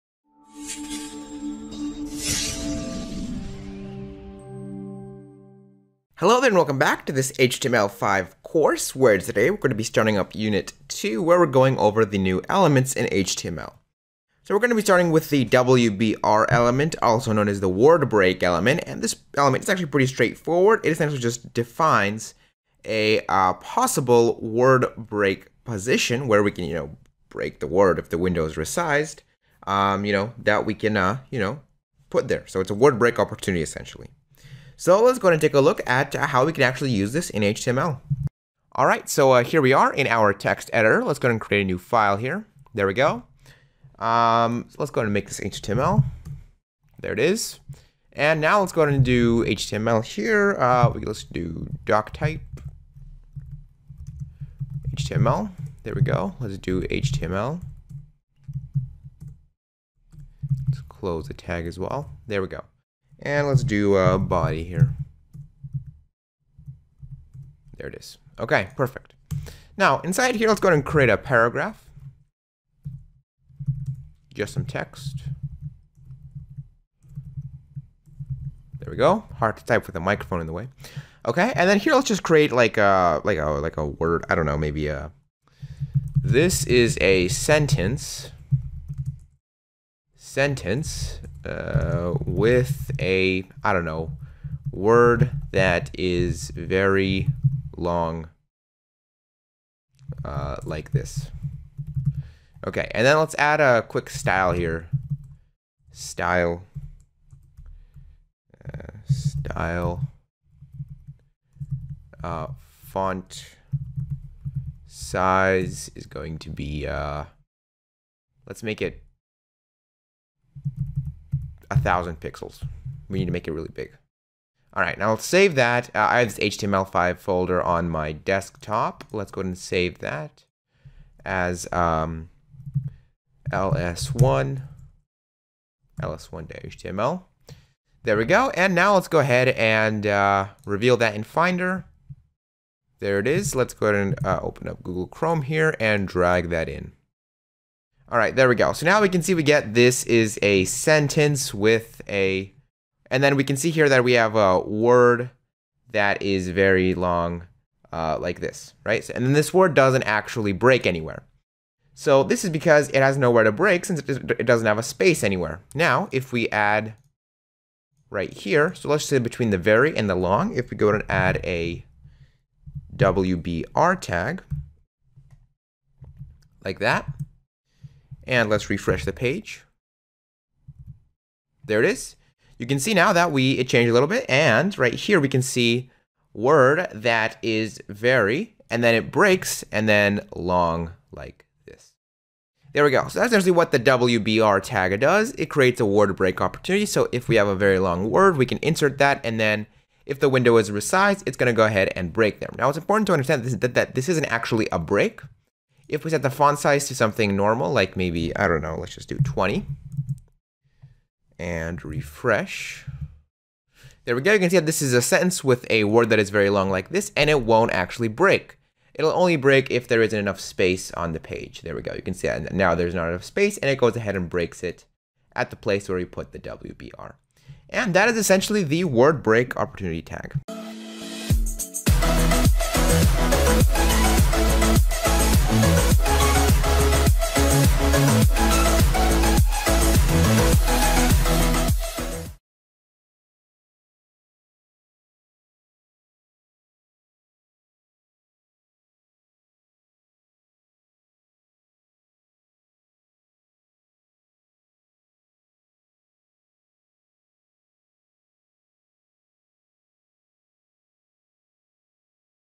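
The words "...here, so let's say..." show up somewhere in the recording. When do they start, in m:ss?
2:48.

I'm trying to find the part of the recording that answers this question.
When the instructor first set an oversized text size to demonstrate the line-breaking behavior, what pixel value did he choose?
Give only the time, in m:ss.
2:01.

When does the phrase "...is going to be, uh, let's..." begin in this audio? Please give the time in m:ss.
1:55.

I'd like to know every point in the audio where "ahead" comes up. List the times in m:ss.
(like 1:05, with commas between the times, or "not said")
1:10, 2:09, 2:19, 2:23, 3:21, 3:43.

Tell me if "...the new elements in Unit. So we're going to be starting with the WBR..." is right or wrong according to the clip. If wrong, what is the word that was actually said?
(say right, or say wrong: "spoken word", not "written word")
wrong: "HTML", not "Unit".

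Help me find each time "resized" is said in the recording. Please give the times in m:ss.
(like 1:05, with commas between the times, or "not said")
0:28, 3:20.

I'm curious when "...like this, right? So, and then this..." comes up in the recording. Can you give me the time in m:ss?
2:38.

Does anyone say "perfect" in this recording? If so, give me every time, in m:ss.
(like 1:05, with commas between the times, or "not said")
1:08.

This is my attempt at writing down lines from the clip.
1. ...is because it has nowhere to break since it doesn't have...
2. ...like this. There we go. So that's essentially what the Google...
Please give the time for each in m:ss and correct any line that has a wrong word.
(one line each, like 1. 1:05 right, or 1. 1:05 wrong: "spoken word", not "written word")
1. 2:42 right
2. 3:11 wrong: "WBR", not "Google".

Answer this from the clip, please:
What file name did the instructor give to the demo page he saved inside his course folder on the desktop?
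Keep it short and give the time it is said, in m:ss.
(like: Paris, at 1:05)
ls1.html, at 2:16.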